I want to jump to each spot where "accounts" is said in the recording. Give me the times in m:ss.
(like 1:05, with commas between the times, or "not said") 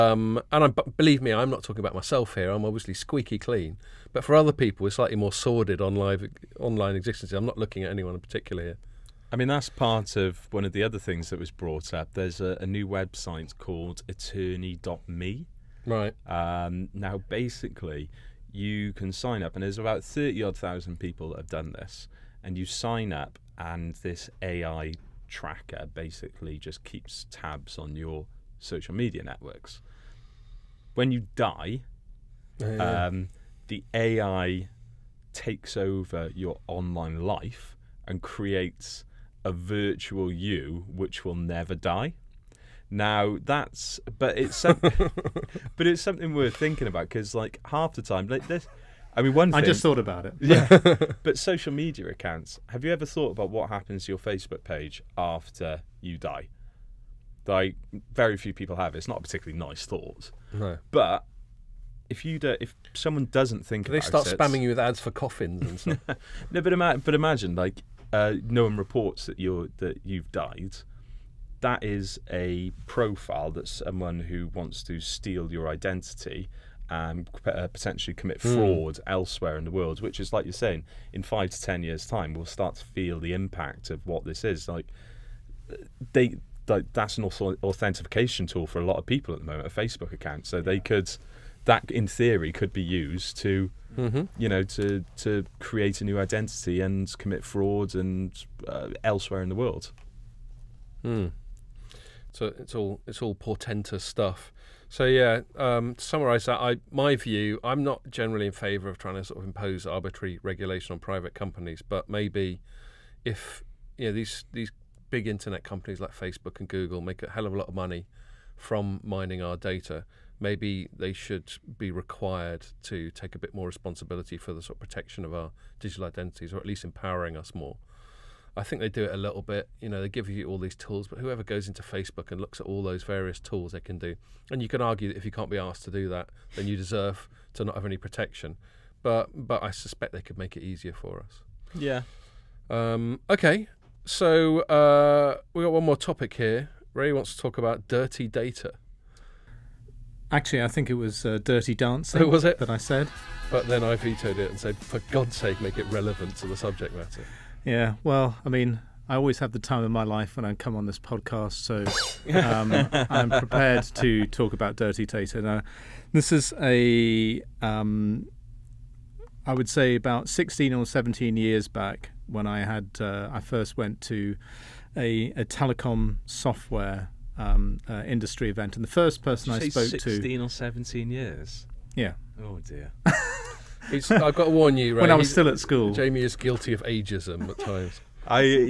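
0:52, 1:30.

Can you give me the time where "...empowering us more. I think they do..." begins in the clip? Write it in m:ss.
2:06.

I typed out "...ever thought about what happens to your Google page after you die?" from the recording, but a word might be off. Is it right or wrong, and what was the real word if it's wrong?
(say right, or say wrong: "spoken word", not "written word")
wrong: "Facebook", not "Google".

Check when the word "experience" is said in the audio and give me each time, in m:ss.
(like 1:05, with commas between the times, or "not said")
not said.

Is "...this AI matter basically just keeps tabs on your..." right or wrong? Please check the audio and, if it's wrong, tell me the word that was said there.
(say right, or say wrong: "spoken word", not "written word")
wrong: "tracker", not "matter".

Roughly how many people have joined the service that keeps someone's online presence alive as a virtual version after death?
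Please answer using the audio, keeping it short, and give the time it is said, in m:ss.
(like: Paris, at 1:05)
30 thousand, at 0:20.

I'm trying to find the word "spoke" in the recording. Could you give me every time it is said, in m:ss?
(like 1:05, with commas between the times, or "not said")
2:59.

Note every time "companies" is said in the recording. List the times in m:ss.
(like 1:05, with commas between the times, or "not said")
1:51, 1:55.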